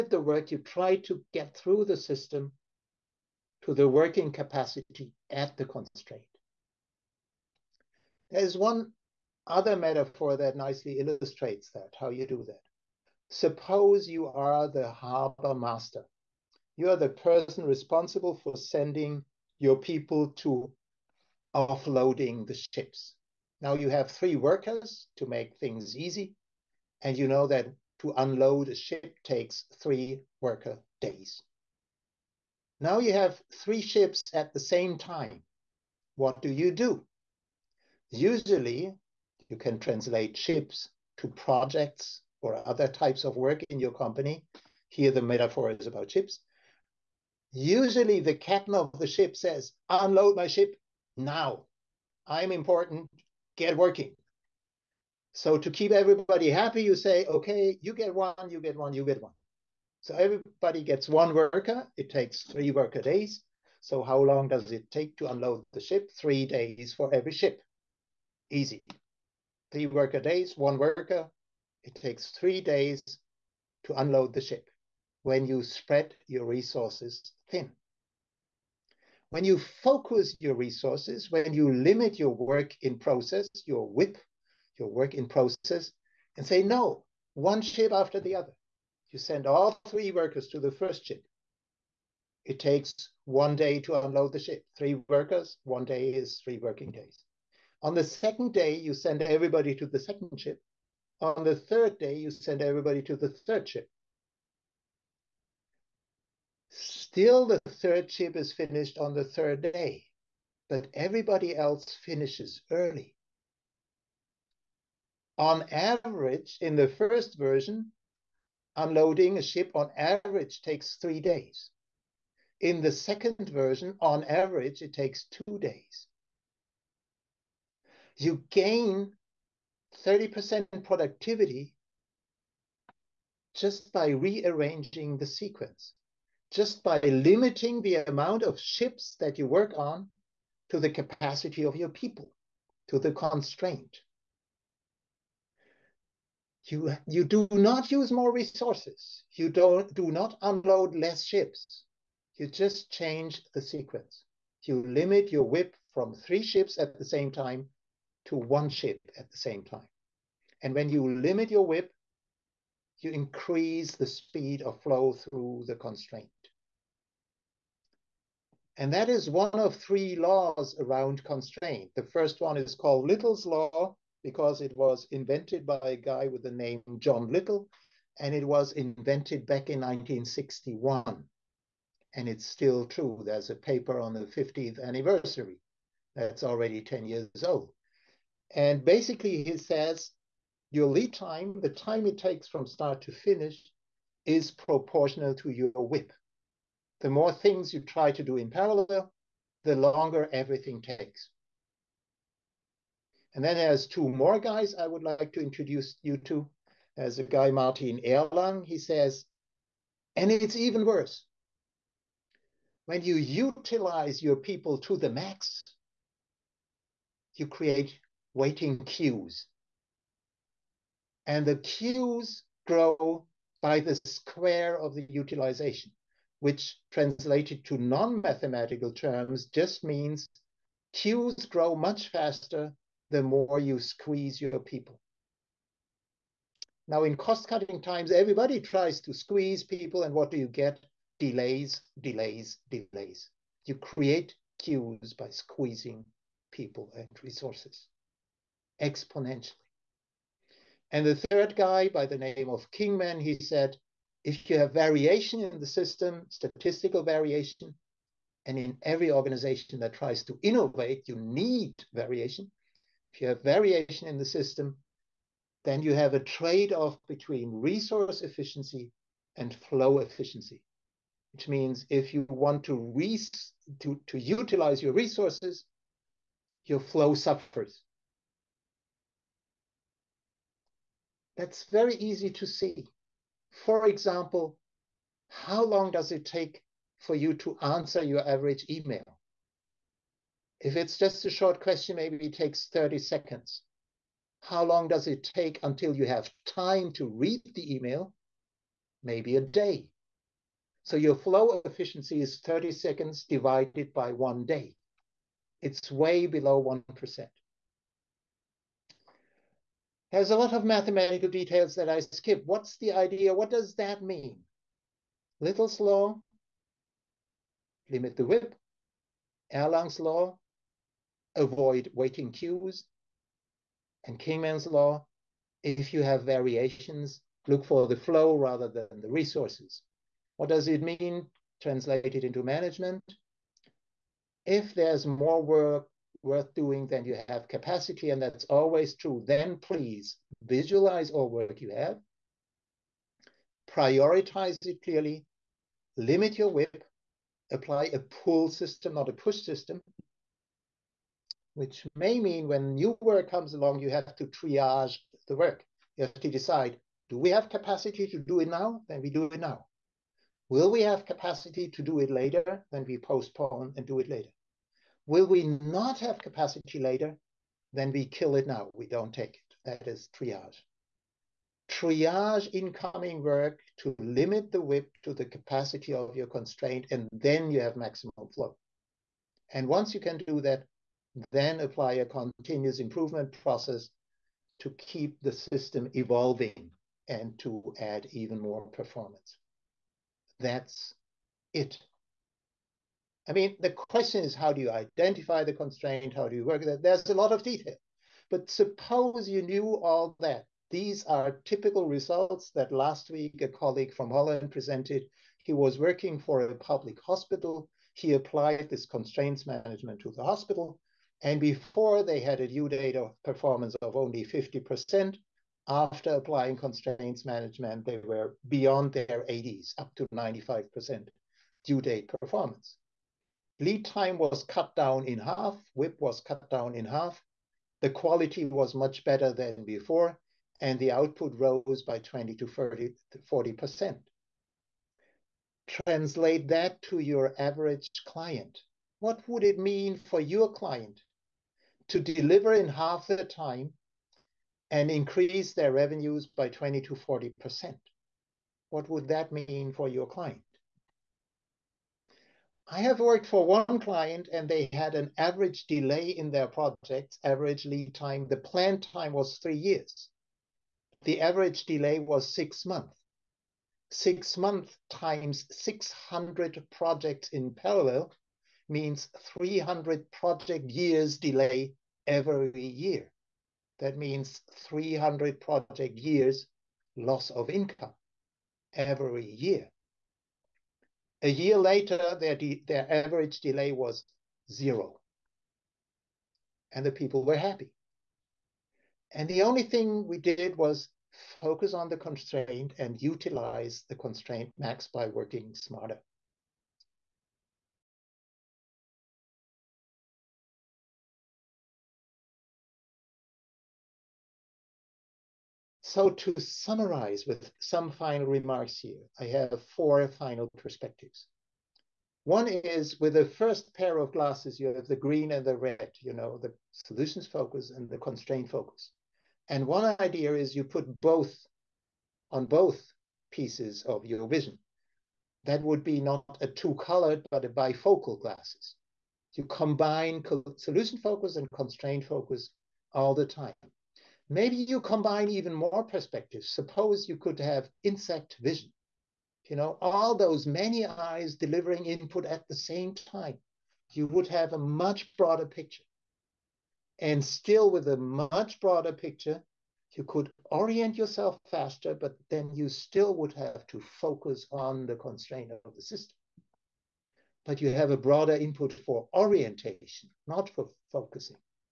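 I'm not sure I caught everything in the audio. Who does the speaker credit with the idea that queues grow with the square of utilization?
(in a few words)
Martin Erlang.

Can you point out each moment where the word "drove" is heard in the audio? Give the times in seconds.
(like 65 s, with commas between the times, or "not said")
not said.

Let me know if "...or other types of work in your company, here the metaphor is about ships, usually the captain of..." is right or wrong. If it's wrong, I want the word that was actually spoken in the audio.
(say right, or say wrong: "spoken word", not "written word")
right.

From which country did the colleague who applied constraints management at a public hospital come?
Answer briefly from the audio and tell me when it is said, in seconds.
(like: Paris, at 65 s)
Holland, at 404 s.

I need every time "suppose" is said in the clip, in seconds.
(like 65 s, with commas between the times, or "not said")
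13 s, 398 s, 536 s.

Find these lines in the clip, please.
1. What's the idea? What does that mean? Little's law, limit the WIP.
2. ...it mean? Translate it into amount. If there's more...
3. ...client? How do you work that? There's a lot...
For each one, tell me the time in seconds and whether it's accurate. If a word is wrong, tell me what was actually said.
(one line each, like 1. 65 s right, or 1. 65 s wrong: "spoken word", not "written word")
1. 312 s right
2. 330 s wrong: "management", not "amount"
3. 395 s wrong: "constraint", not "client".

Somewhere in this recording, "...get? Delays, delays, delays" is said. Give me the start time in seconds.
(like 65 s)
240 s.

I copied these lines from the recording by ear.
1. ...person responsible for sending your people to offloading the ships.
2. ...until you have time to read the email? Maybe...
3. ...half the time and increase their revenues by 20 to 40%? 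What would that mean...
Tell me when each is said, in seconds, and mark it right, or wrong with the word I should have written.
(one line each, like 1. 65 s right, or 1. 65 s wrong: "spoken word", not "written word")
1. 17 s right
2. 295 s right
3. 442 s right.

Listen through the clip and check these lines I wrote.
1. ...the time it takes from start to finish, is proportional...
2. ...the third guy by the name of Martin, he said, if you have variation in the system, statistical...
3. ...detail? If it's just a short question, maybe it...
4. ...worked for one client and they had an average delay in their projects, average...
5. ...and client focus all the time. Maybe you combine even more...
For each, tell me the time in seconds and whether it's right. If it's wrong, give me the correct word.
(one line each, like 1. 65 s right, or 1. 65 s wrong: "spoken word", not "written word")
1. 191 s right
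2. 251 s wrong: "Kingman", not "Martin"
3. 288 s wrong: "email", not "detail"
4. 453 s right
5. 531 s wrong: "constraint", not "client".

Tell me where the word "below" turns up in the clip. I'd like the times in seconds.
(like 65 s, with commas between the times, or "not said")
306 s.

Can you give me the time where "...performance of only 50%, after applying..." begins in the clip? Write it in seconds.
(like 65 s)
413 s.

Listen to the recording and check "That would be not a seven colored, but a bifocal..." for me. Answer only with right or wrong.
wrong.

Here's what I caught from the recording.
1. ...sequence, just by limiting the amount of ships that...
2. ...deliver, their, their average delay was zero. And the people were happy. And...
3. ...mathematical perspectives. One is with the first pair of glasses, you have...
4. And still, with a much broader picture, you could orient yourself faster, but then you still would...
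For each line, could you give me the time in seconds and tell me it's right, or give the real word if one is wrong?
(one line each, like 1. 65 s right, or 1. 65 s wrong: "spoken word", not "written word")
1. 135 s right
2. 481 s wrong: "later", not "deliver"
3. 510 s wrong: "final", not "mathematical"
4. 546 s right.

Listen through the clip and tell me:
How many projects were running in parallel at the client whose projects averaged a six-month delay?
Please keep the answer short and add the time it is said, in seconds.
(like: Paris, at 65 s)
600, at 465 s.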